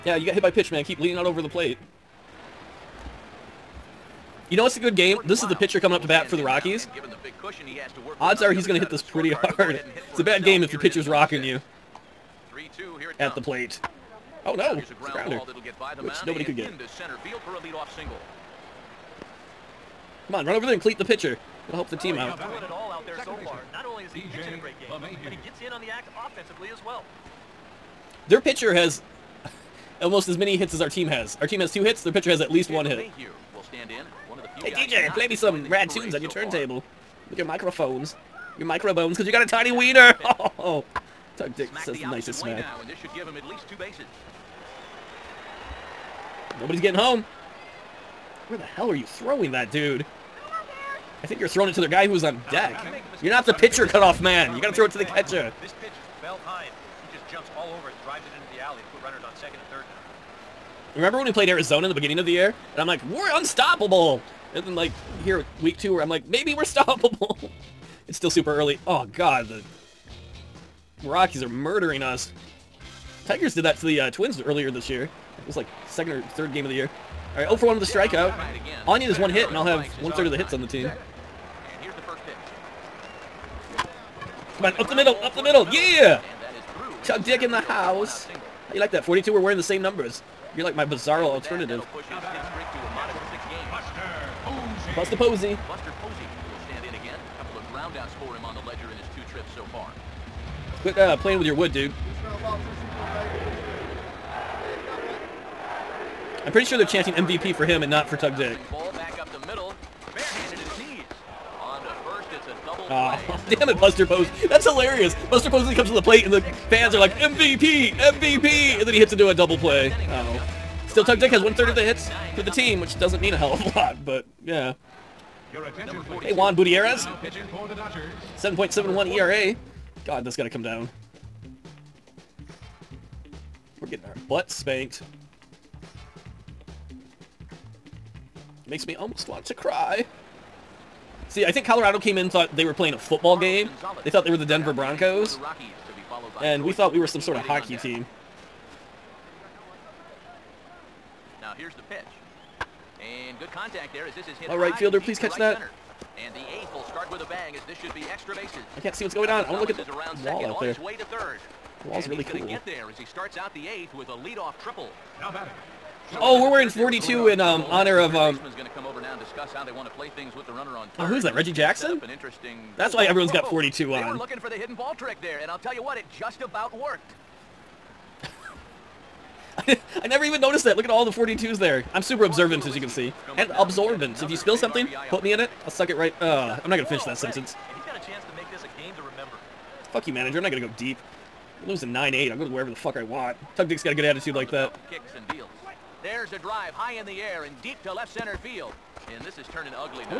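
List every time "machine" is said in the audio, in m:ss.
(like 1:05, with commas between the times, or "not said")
not said.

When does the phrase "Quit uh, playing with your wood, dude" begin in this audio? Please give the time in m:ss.
1:40.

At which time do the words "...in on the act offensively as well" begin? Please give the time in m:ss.
0:25.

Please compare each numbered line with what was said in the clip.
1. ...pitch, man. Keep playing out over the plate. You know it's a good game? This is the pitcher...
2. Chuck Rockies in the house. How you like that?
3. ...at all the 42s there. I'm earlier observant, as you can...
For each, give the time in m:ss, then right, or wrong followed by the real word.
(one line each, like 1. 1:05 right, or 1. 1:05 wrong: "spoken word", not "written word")
1. 0:00 wrong: "leaning", not "playing"
2. 1:27 wrong: "Dick", not "Rockies"
3. 3:00 wrong: "super", not "earlier".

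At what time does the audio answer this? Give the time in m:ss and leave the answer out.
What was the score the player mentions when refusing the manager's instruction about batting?
3:11.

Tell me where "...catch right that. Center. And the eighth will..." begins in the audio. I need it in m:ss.
2:35.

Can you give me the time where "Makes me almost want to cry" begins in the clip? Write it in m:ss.
2:18.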